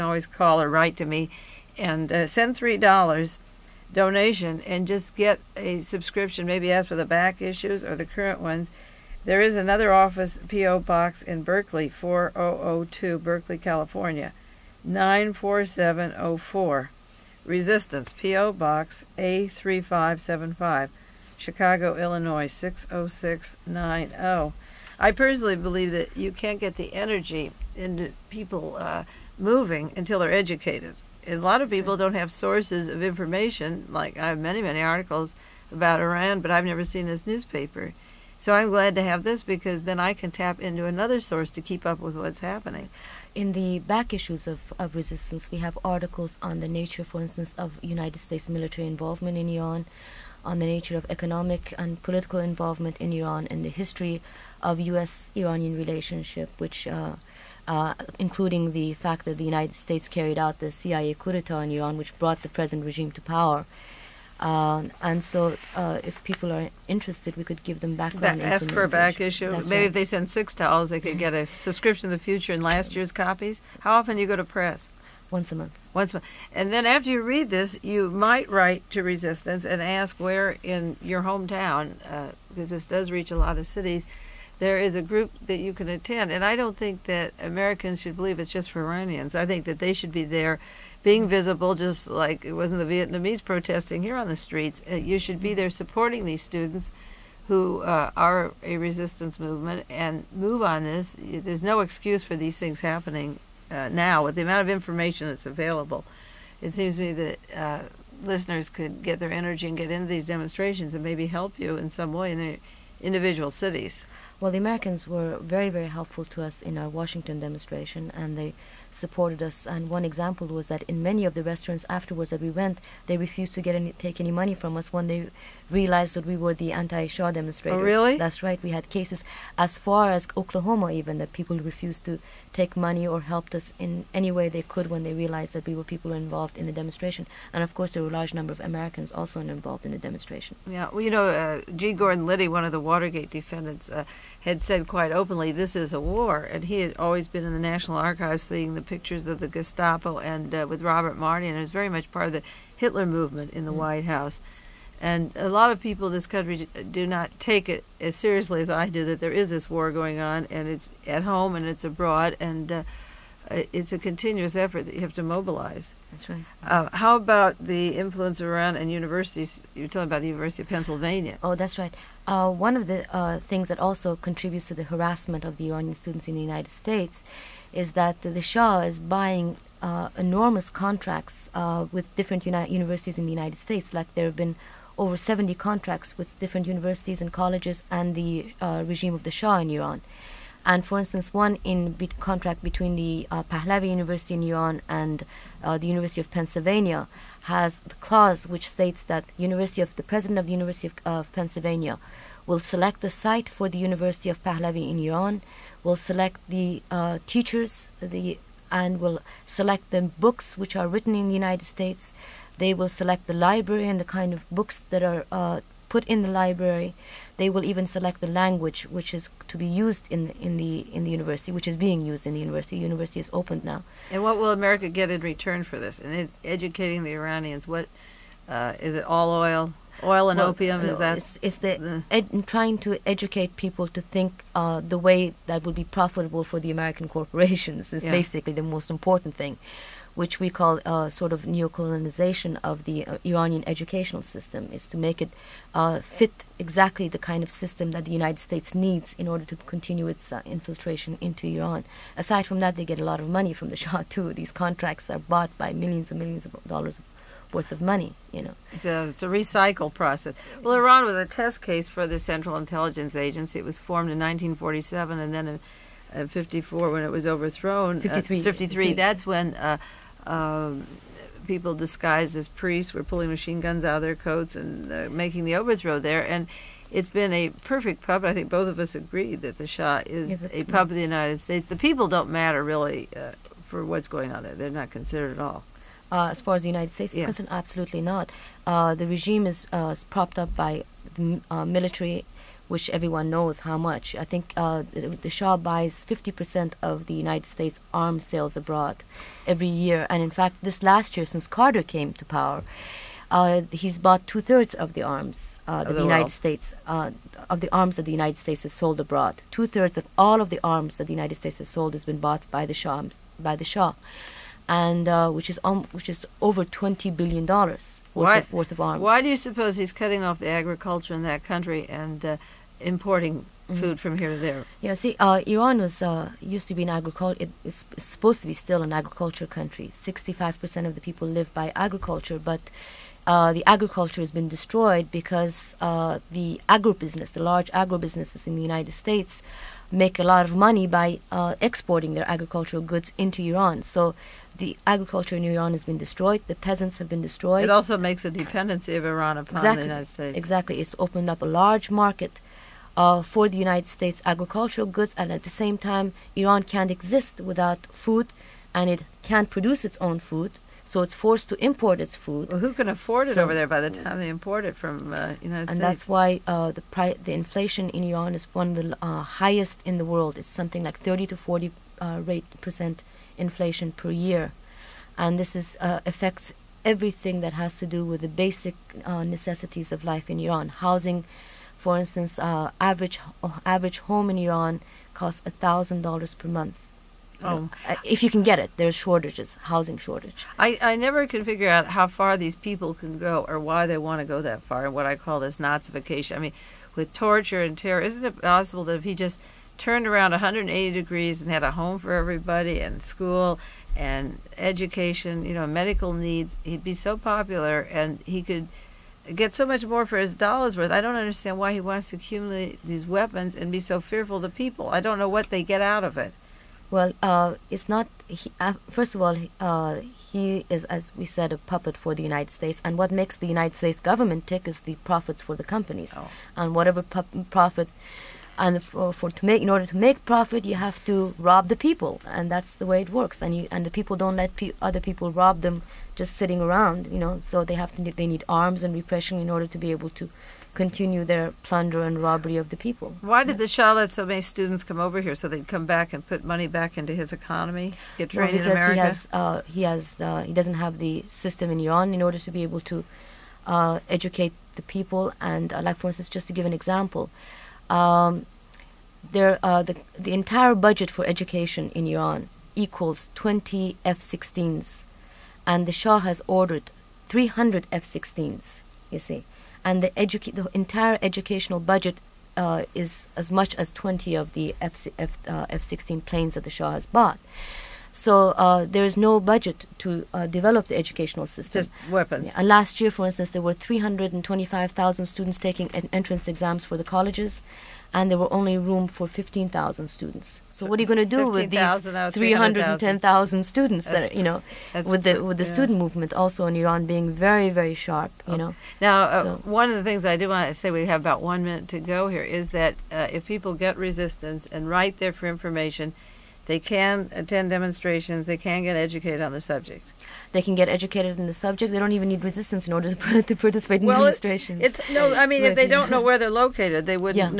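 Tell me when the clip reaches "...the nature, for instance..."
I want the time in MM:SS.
00:46.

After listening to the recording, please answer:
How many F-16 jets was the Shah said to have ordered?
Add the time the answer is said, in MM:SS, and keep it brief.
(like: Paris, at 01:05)
300, at 07:47.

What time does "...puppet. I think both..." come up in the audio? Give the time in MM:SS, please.
04:38.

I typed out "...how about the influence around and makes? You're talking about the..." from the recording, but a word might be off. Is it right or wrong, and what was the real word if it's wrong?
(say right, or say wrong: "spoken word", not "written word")
wrong: "universities", not "makes".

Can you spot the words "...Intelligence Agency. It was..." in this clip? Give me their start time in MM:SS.
04:22.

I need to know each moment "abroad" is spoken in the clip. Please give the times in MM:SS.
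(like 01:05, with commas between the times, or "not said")
02:41, 04:58, 05:08.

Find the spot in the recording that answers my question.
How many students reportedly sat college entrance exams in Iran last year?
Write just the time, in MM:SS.
08:03.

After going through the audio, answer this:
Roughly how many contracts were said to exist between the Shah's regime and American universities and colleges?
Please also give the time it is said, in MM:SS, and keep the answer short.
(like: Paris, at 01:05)
Over 70, at 03:04.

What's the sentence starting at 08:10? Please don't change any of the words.
So, so what are you going to do 15, with these 310,000 students that you know with the with the yeah.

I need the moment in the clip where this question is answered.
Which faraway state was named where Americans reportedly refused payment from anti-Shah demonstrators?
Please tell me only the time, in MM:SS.
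02:10.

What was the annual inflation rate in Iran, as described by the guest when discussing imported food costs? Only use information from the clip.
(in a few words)
30 to 40 percent.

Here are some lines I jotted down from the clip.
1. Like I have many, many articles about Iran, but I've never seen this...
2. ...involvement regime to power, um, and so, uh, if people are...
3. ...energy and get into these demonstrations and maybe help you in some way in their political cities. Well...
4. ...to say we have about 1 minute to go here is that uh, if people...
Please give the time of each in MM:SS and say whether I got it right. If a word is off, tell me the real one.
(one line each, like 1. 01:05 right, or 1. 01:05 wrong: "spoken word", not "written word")
1. 00:33 right
2. 01:02 wrong: "present", not "involvement"
3. 01:49 wrong: "individual", not "political"
4. 08:20 right.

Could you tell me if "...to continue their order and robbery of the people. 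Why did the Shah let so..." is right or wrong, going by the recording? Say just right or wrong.
wrong.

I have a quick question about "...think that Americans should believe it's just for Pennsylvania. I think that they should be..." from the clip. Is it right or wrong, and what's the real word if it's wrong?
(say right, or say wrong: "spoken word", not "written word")
wrong: "Iranians", not "Pennsylvania".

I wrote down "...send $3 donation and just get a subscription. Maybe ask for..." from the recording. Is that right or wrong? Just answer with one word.
right.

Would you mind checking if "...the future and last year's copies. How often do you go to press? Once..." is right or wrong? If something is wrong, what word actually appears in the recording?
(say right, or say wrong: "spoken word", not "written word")
right.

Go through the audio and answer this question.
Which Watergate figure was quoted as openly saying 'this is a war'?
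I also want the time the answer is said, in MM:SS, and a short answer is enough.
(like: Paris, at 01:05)
G. Gordon Liddy, at 02:21.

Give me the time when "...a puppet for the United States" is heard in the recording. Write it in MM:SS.
07:01.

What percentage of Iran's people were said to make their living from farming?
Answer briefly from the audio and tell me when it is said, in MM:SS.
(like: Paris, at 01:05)
65%, at 05:30.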